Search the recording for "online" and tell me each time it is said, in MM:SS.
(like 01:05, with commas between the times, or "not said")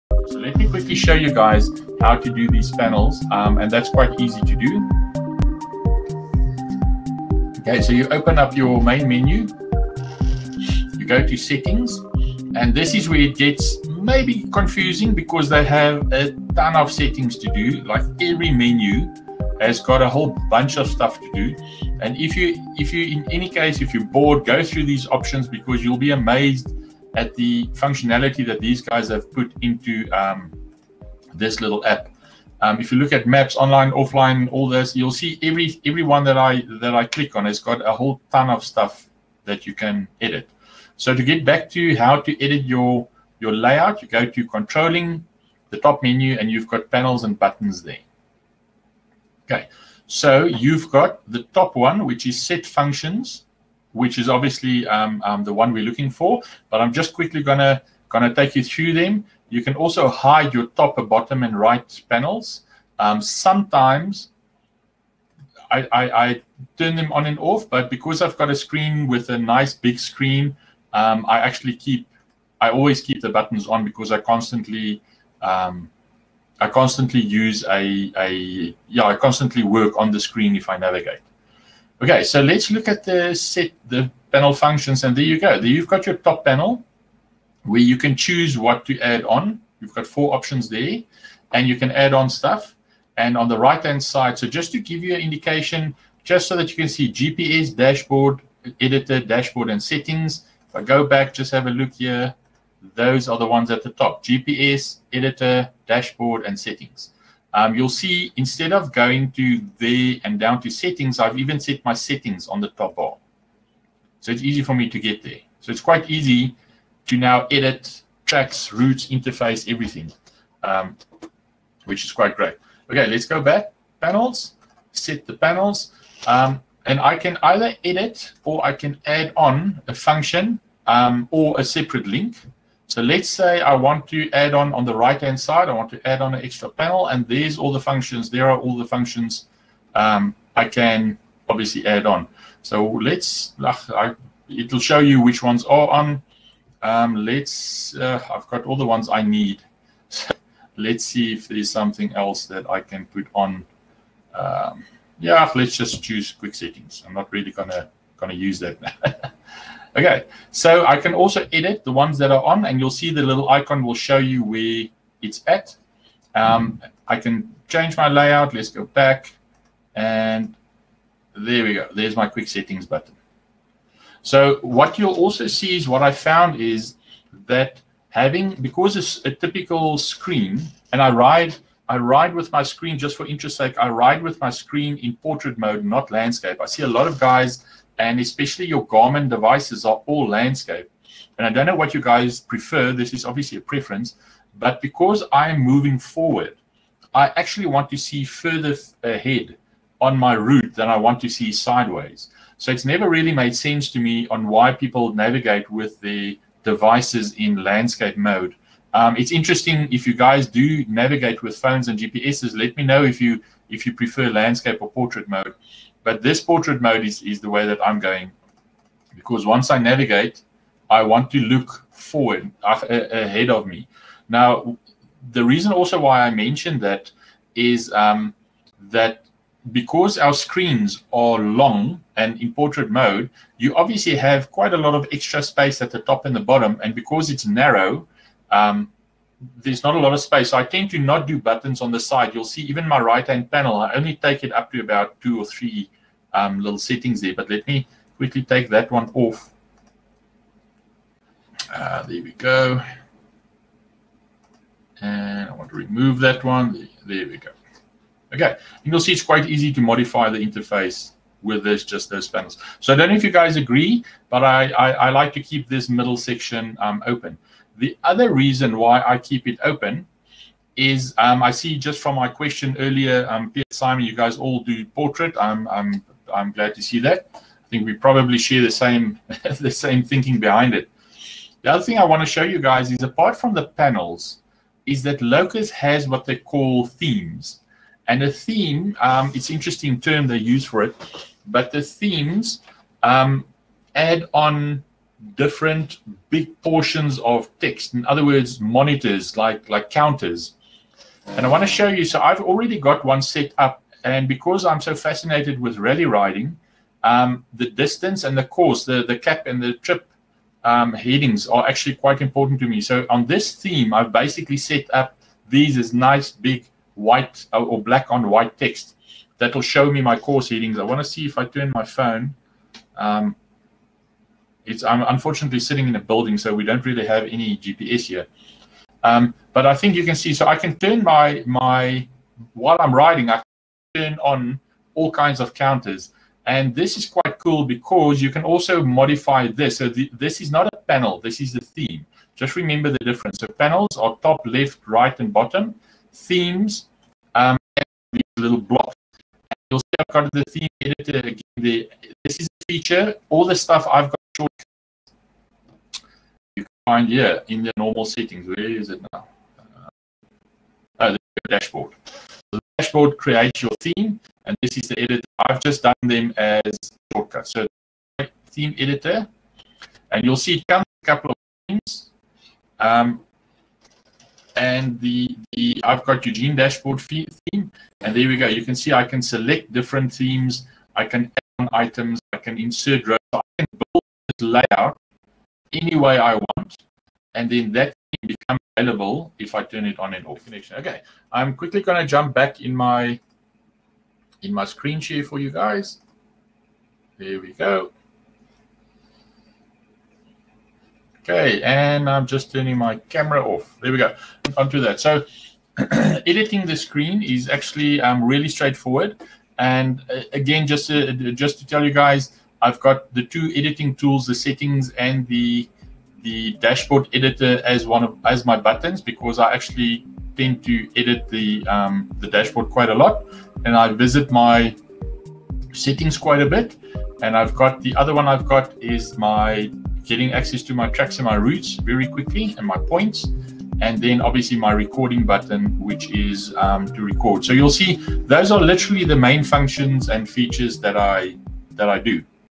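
00:33.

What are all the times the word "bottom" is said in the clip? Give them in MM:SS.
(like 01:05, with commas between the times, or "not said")
01:01, 03:56, 05:45.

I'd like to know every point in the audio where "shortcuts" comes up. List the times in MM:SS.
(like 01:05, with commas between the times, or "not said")
05:54, 06:07.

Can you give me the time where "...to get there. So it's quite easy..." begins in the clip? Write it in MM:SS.
01:54.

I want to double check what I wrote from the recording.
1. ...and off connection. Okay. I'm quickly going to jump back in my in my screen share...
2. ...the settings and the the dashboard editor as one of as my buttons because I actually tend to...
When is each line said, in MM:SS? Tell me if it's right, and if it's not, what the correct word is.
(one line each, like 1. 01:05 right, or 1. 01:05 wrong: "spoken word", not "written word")
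1. 06:30 right
2. 06:54 right.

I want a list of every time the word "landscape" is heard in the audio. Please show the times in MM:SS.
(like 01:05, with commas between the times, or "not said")
03:06, 03:10, 03:27, 03:34.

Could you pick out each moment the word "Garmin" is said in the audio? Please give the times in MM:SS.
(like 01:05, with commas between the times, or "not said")
03:08.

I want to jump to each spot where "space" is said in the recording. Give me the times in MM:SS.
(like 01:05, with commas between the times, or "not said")
03:55, 04:00.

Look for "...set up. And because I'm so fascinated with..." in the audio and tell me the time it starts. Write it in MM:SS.
05:03.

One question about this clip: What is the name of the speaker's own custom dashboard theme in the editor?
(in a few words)
Eugene dashboard theme.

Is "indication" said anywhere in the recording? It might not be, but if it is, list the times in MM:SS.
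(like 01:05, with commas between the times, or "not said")
01:35.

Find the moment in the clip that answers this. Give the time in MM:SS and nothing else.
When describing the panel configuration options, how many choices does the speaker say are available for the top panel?
01:30.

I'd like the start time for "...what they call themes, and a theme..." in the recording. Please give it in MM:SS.
04:46.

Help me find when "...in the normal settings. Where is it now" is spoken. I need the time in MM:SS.
05:57.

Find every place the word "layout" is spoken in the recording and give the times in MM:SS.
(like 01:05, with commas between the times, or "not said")
00:43, 02:48, 06:24.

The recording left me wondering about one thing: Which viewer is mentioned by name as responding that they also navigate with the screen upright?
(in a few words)
Pierre Simon.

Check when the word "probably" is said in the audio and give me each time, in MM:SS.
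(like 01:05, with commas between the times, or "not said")
04:37.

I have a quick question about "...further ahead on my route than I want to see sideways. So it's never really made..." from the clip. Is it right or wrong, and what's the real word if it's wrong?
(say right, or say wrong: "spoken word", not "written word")
right.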